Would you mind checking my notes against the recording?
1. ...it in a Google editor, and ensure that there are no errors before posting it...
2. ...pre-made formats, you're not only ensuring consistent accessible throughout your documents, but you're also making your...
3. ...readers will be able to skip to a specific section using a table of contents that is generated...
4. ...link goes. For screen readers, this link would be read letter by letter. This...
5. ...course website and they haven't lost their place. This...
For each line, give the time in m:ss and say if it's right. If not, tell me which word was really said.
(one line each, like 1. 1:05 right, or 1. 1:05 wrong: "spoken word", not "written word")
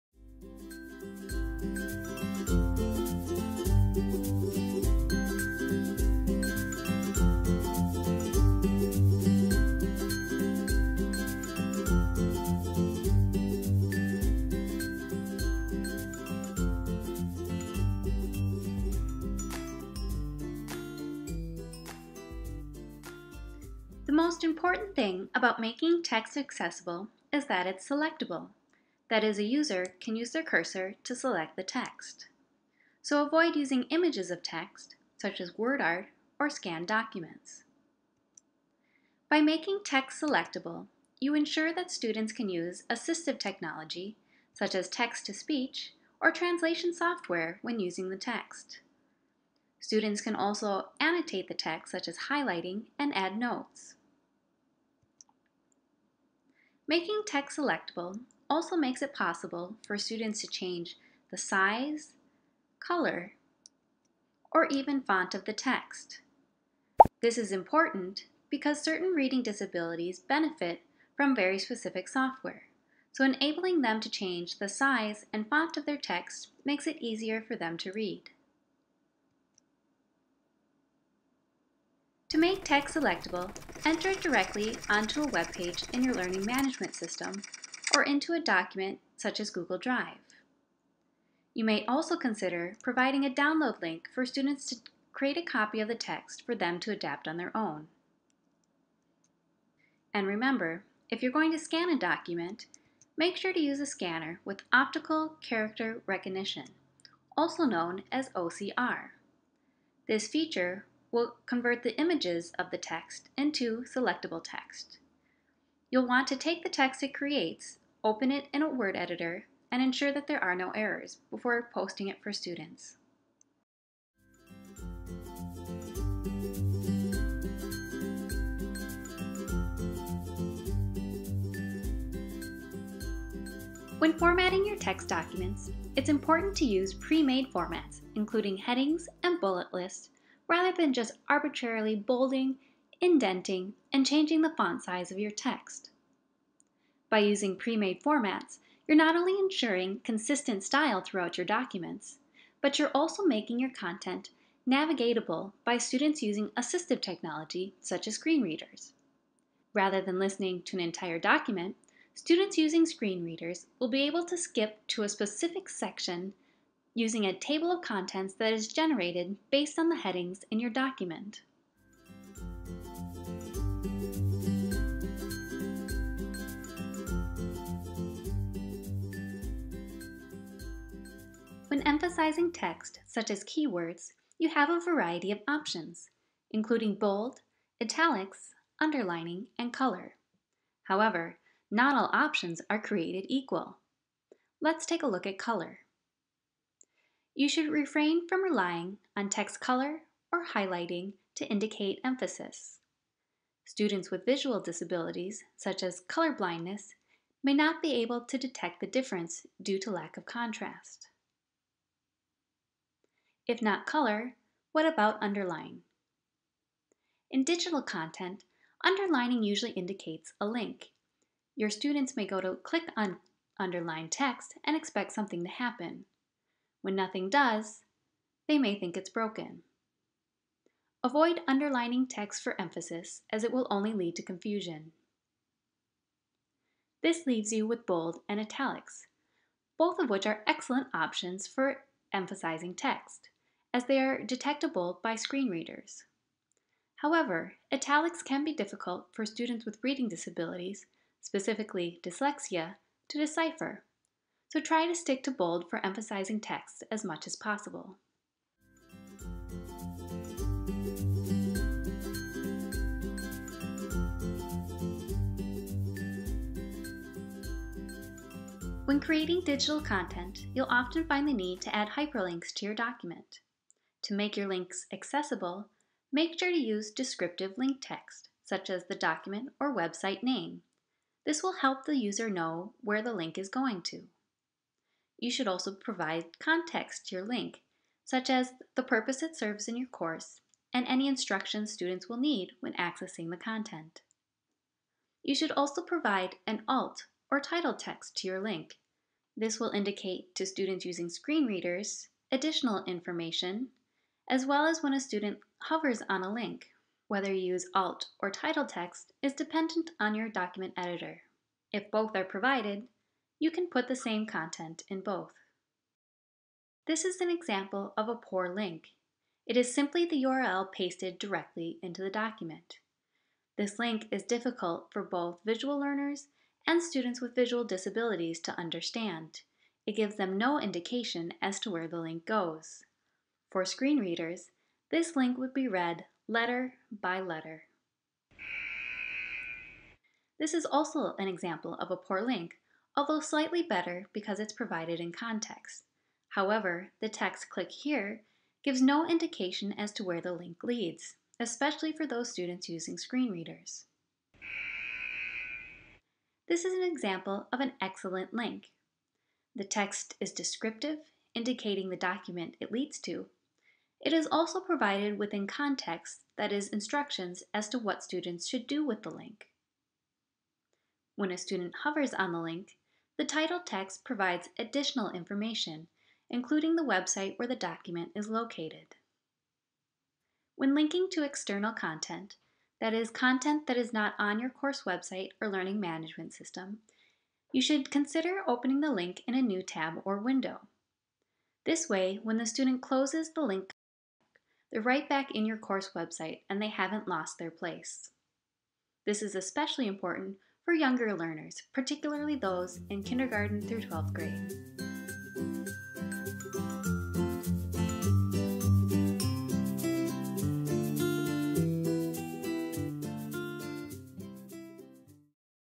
1. 1:58 wrong: "Word", not "Google"
2. 2:27 wrong: "style", not "accessible"
3. 2:43 right
4. 5:31 right
5. 6:35 right.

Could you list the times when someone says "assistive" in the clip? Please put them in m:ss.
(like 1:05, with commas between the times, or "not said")
0:42, 2:36.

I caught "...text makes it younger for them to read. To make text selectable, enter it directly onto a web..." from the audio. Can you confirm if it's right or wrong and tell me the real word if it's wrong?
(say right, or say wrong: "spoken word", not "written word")
wrong: "easier", not "younger".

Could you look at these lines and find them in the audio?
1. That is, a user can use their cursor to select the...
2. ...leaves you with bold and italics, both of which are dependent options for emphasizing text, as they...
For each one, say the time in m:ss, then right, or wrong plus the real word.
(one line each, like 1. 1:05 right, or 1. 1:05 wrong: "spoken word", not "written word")
1. 0:29 right
2. 3:57 wrong: "excellent", not "dependent".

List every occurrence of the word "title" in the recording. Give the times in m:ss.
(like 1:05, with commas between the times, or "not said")
4:57, 5:08, 6:13.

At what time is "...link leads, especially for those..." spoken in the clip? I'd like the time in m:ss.
5:50.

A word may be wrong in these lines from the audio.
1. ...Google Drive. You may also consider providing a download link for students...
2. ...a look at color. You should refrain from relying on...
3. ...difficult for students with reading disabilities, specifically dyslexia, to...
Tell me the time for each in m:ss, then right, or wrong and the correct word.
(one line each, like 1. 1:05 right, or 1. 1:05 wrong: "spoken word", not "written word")
1. 1:29 right
2. 3:15 right
3. 4:08 right.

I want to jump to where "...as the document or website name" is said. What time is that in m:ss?
4:38.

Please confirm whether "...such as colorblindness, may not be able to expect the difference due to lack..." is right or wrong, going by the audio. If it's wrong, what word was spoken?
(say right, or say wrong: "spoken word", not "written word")
wrong: "detect", not "expect".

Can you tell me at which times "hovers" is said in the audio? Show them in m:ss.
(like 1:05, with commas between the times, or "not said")
5:05, 6:11.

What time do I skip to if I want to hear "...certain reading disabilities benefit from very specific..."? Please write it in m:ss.
1:08.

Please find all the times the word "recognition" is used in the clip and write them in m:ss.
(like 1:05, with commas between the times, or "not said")
1:46.